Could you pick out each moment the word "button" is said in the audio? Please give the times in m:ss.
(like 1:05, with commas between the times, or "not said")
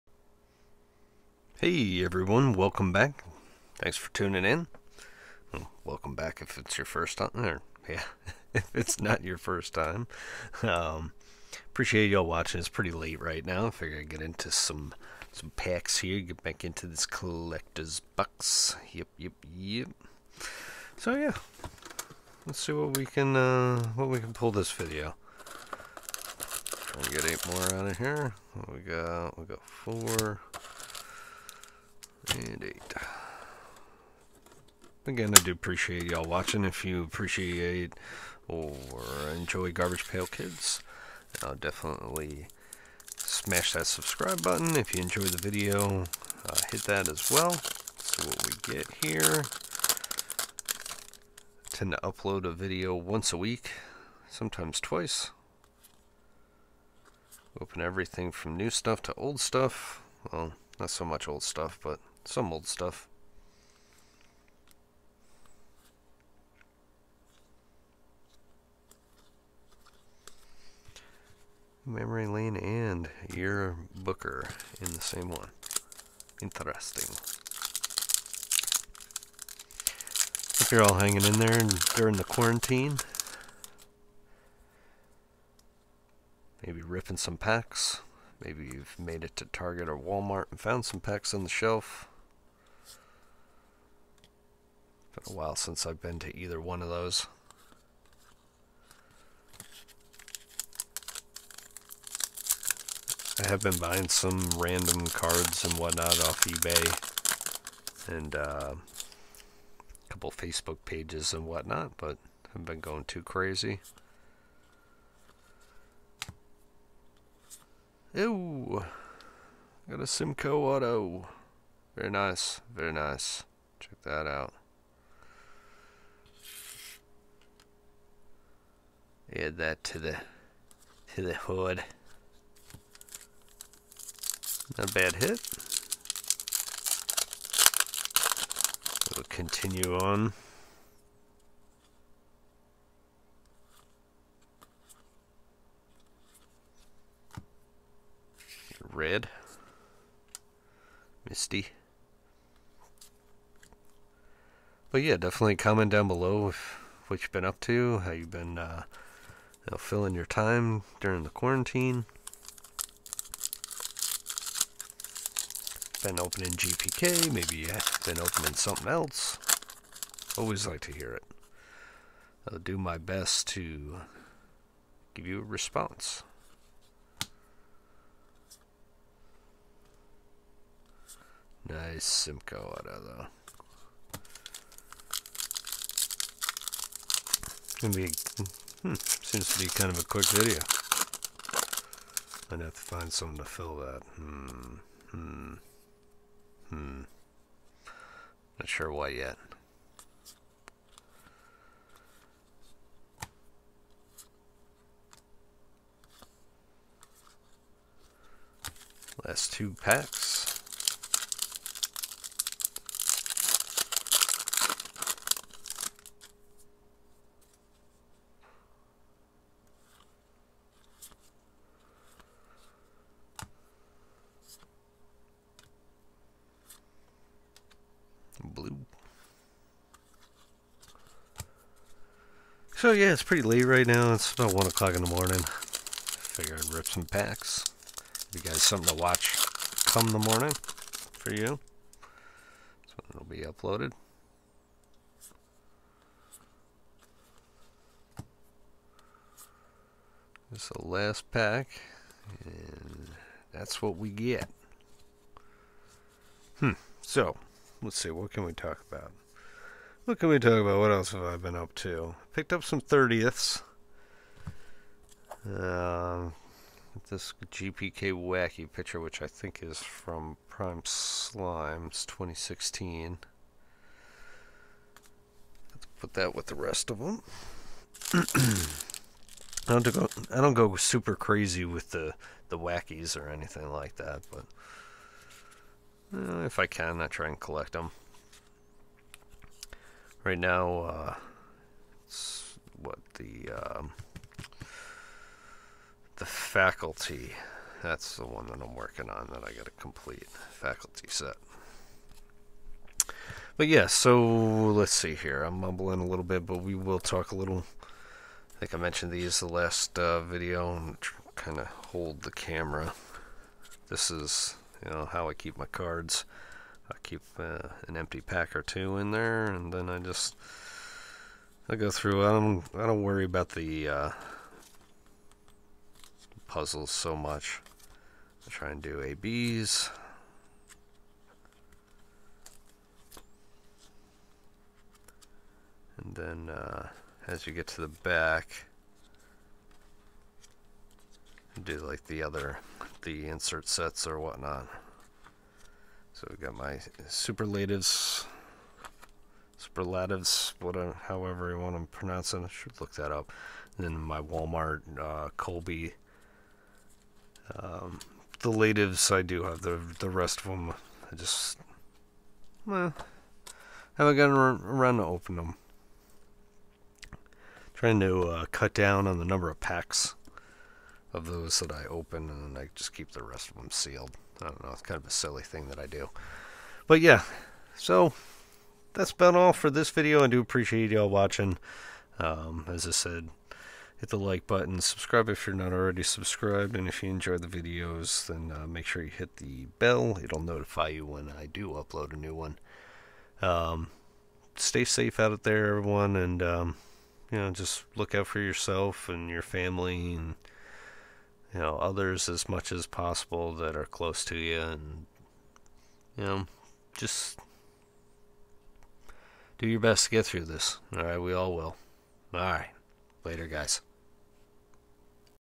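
0:44, 6:24.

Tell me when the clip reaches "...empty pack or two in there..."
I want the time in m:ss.
5:17.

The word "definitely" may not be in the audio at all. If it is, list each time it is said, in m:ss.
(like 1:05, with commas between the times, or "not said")
0:41, 2:35.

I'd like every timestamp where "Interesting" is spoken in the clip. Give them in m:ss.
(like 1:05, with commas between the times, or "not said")
1:16.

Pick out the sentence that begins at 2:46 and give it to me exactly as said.
Been opening GPK, maybe you have been opening something else.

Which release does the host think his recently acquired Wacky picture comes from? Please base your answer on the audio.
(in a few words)
Prime Slimes 2016.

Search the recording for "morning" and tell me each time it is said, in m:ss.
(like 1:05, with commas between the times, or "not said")
3:55, 4:00.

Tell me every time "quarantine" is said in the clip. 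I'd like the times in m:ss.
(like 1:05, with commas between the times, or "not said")
1:22, 2:41.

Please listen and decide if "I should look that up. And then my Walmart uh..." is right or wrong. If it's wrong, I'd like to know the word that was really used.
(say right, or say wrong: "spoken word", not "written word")
right.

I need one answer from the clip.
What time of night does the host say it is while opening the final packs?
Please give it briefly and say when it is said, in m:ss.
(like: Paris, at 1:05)
1 o'clock, at 3:54.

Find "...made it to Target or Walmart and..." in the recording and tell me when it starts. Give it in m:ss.
1:28.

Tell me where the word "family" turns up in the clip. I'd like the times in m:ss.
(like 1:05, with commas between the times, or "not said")
6:39.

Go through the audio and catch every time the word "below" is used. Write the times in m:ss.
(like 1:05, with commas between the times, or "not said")
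2:36.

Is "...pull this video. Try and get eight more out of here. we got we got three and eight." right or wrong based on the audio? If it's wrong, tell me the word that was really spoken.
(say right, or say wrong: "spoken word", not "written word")
wrong: "four", not "three".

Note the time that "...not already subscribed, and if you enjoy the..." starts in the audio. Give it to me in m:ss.
6:25.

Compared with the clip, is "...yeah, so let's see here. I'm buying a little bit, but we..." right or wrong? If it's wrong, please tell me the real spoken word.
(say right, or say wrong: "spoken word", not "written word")
wrong: "mumbling", not "buying".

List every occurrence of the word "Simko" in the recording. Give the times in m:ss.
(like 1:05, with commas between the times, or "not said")
2:00, 3:02.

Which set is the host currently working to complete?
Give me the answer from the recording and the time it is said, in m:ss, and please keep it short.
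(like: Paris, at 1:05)
faculty set, at 5:00.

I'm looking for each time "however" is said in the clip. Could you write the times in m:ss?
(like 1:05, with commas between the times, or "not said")
5:51.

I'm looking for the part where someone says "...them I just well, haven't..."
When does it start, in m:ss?
6:00.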